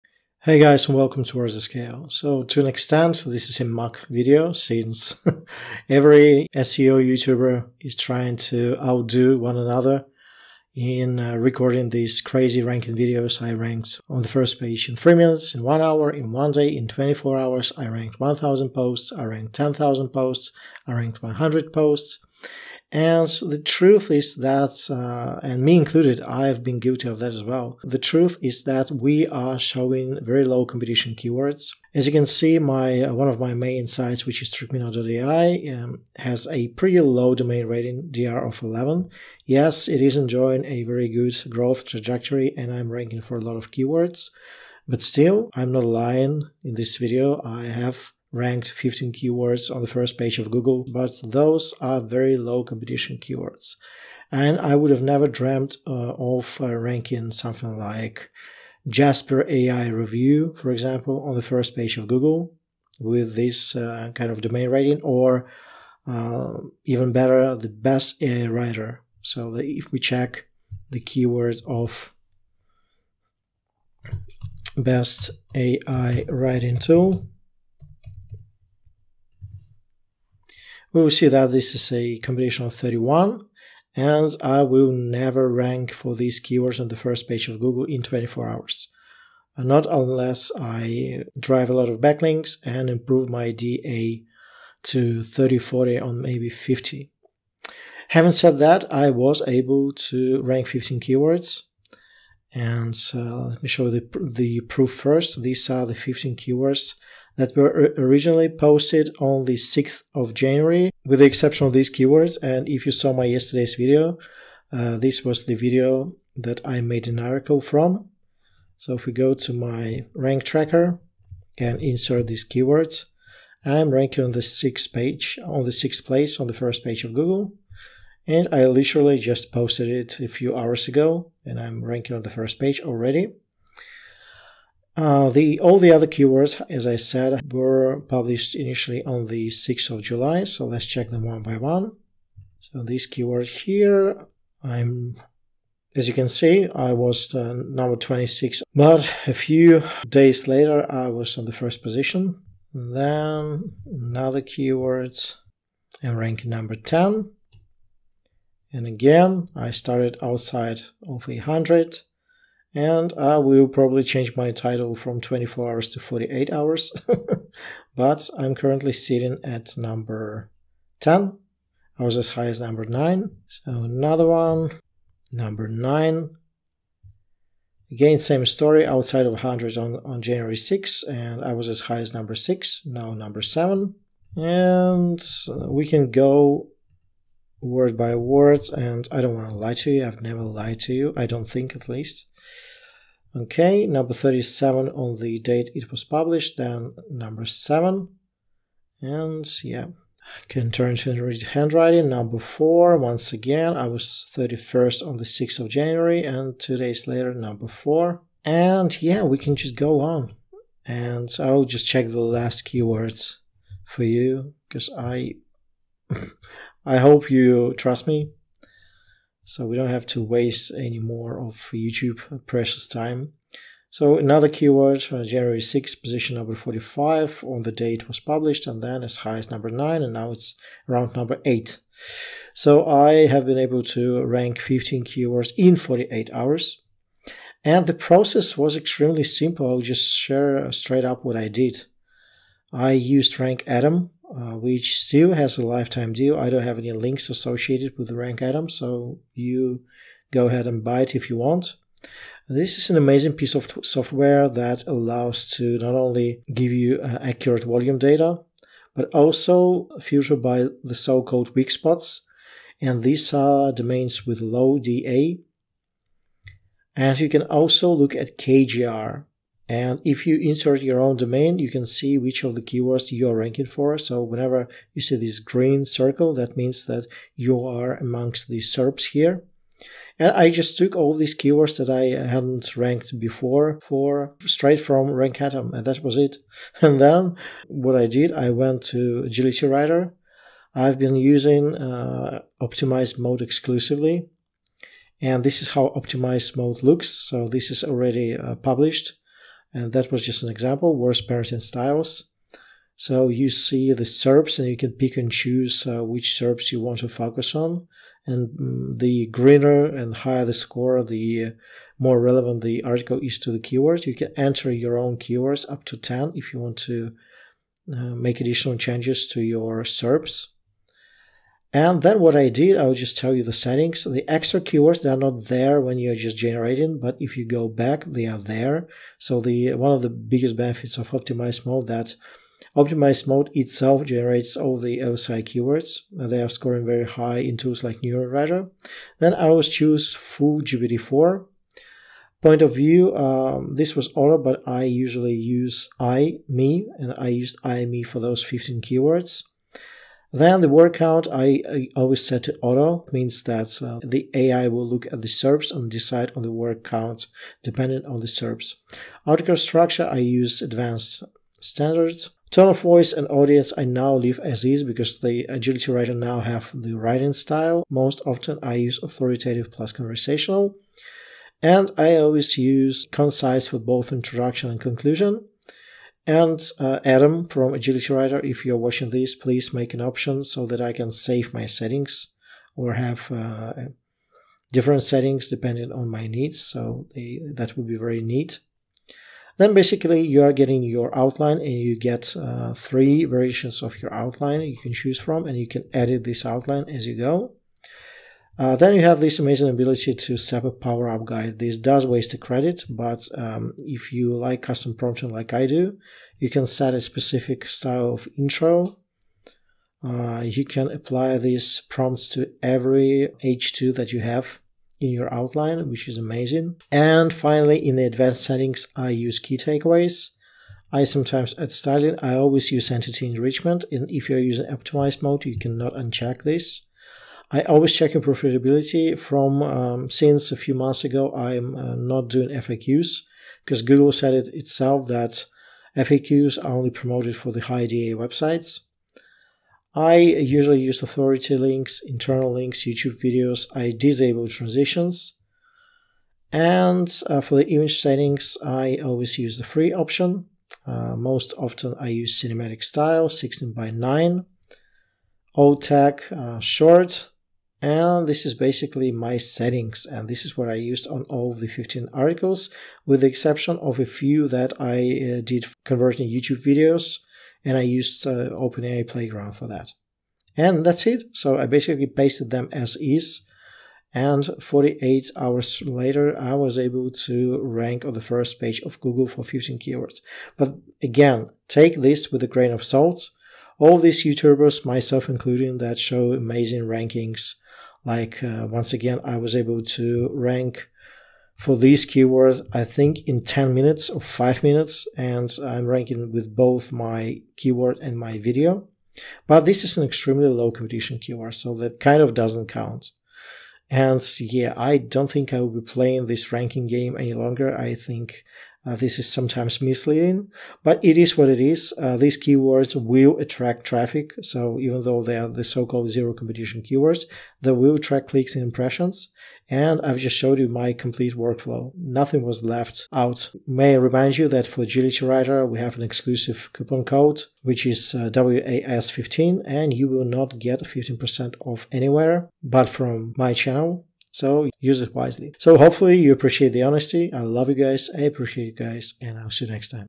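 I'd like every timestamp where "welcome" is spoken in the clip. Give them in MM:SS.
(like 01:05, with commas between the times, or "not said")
00:00.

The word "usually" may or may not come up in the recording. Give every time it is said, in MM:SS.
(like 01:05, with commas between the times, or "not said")
05:44, 07:20.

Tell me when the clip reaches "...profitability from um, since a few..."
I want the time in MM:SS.
07:08.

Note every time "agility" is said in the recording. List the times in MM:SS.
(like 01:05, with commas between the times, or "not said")
04:49, 06:05, 06:17, 08:44.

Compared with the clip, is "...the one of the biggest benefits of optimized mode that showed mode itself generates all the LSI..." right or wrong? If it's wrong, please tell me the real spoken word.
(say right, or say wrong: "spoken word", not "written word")
wrong: "optimized", not "showed".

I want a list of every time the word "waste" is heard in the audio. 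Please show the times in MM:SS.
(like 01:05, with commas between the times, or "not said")
03:40, 06:42.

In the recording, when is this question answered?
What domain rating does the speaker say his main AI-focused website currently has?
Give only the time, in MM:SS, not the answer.
00:38.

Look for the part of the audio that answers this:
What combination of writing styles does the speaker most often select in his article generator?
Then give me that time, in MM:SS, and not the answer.
06:09.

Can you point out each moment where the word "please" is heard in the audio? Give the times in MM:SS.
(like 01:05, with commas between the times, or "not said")
06:19.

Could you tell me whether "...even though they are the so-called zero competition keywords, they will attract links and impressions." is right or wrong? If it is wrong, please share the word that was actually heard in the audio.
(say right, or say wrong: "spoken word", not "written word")
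wrong: "clicks", not "links".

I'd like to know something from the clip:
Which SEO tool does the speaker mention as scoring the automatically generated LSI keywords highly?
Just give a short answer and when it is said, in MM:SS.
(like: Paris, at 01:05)
NeuronWriter, at 05:38.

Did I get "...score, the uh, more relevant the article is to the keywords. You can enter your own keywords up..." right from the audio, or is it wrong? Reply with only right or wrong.
right.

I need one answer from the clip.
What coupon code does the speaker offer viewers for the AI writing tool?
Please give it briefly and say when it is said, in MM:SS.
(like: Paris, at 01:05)
WAS15, at 08:48.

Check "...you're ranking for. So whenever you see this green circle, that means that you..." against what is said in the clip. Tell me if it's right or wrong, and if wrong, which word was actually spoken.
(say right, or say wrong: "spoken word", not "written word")
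right.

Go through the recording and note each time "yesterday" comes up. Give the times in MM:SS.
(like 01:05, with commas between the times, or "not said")
01:53.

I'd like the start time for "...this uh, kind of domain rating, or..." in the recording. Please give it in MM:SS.
01:03.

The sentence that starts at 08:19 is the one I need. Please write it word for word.
But this is an extremely low competition keyword, so that kind of doesn't count.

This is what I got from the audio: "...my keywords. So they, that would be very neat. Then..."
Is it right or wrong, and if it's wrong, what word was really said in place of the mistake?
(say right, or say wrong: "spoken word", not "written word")
wrong: "needs", not "keywords".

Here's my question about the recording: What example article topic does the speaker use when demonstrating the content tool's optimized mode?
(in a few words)
worst parenting styles.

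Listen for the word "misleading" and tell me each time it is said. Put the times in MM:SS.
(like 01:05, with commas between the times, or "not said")
08:29.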